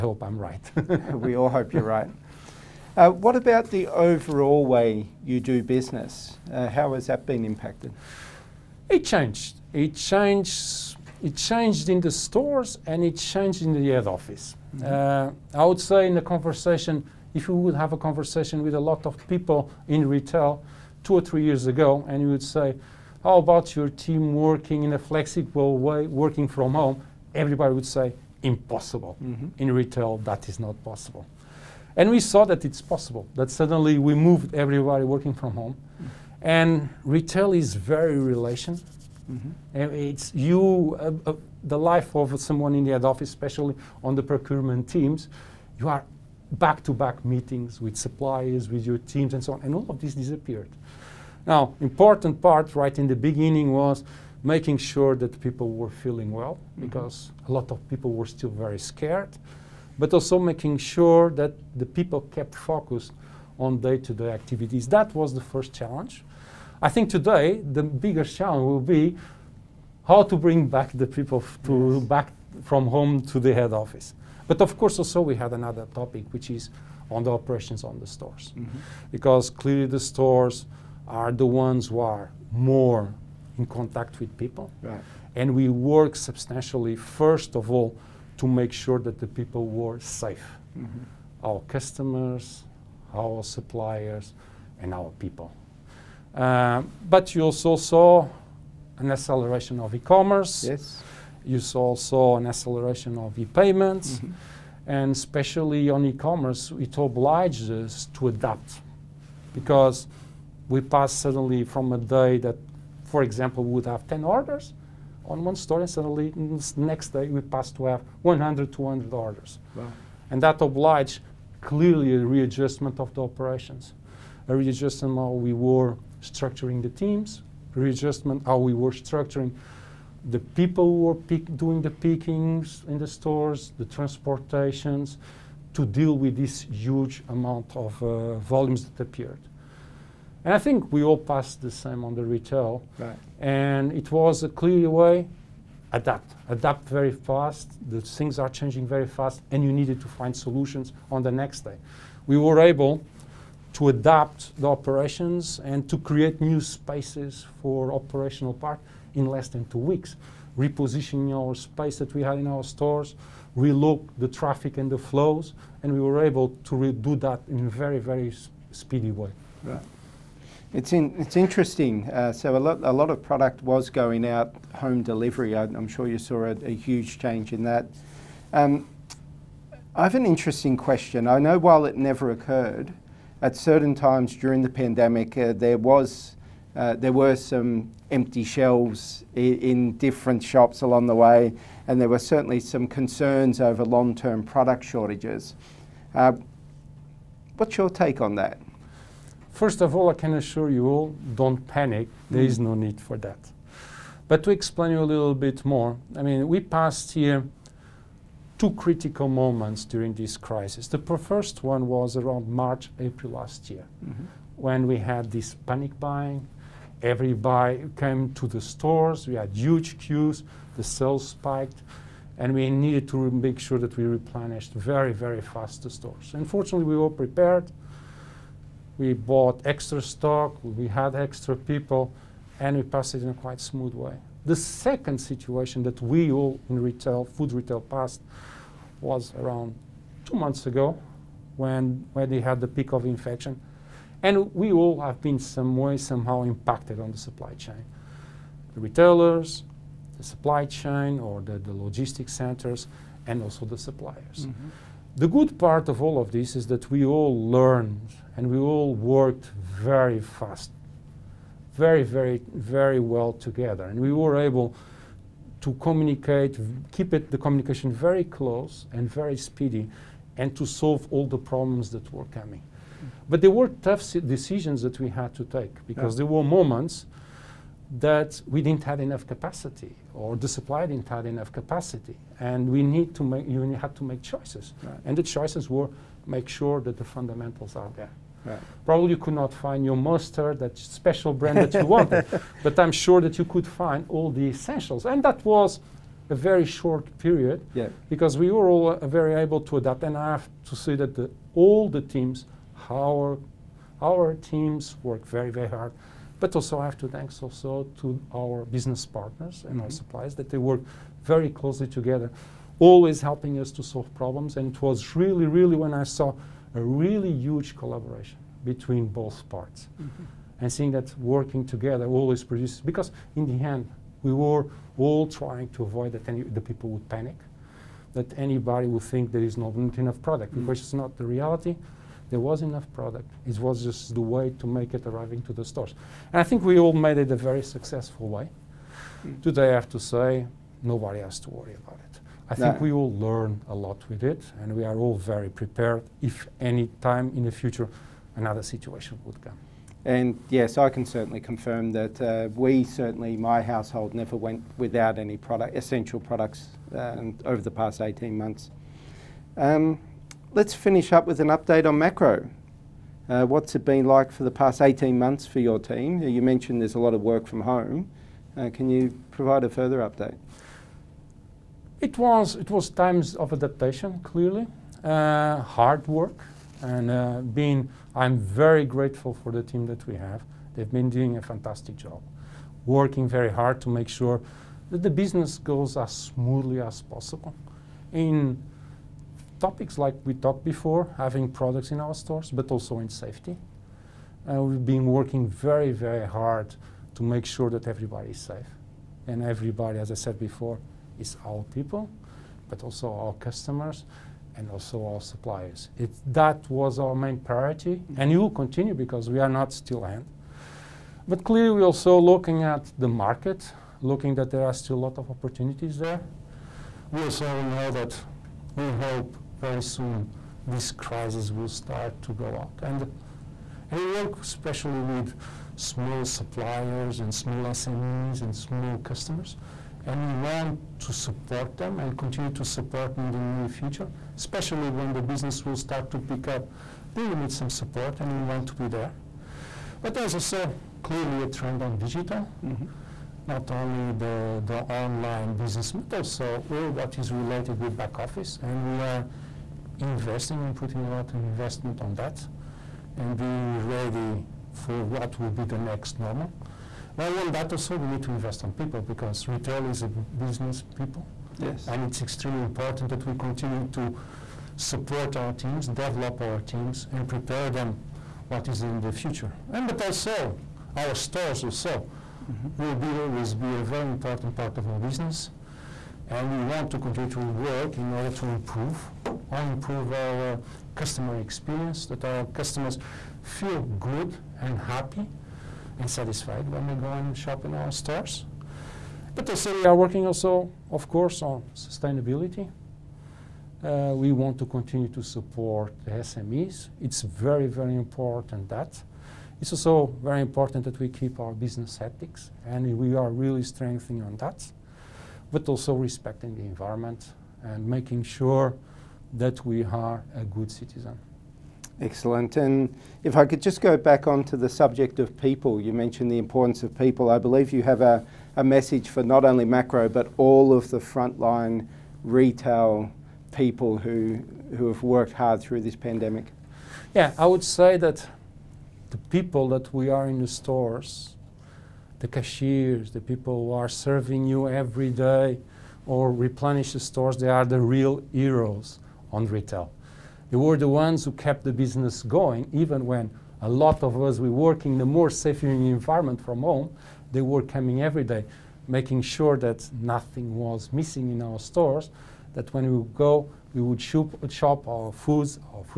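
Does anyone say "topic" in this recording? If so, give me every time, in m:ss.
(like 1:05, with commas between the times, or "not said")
1:16, 6:29.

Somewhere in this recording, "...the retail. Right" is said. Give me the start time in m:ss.
2:22.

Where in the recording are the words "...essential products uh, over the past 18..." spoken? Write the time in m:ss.
5:55.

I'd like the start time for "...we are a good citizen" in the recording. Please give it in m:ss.
8:29.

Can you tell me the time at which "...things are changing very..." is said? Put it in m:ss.
2:28.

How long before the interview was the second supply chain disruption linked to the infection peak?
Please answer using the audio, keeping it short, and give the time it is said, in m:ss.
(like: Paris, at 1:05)
Two months ago, at 4:00.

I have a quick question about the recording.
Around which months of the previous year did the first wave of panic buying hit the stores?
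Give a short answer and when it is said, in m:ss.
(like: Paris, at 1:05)
March, April, at 3:32.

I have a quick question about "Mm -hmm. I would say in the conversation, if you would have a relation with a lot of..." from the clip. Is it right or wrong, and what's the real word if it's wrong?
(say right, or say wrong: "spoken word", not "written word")
wrong: "conversation", not "relation".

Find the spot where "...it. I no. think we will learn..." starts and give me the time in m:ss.
5:42.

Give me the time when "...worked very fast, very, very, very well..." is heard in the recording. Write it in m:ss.
4:18.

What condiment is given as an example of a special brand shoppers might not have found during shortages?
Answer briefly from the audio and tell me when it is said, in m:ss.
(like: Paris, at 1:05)
Mustard, at 4:49.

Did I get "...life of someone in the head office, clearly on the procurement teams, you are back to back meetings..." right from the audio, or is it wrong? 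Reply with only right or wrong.
wrong.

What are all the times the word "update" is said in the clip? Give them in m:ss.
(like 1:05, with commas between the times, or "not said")
6:01, 6:10.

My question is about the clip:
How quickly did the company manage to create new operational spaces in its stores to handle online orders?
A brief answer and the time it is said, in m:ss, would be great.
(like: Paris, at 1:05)
Less than two weeks, at 2:39.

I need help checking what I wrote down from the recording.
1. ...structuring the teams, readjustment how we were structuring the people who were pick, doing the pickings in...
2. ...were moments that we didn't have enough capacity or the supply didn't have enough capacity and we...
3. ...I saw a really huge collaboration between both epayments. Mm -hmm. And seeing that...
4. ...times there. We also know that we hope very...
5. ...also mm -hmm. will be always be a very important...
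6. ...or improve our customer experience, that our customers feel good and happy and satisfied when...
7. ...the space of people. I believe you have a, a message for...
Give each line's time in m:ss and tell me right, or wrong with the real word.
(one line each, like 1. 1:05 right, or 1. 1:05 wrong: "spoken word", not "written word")
1. 2:06 right
2. 4:36 right
3. 5:16 wrong: "parts", not "epayments"
4. 6:55 wrong: "opportunities", not "times"
5. 7:51 right
6. 7:59 right
7. 8:36 wrong: "importance", not "space".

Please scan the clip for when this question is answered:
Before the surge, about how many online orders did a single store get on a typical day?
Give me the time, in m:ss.
1:54.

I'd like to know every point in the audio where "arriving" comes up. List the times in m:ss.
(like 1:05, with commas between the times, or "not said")
5:35.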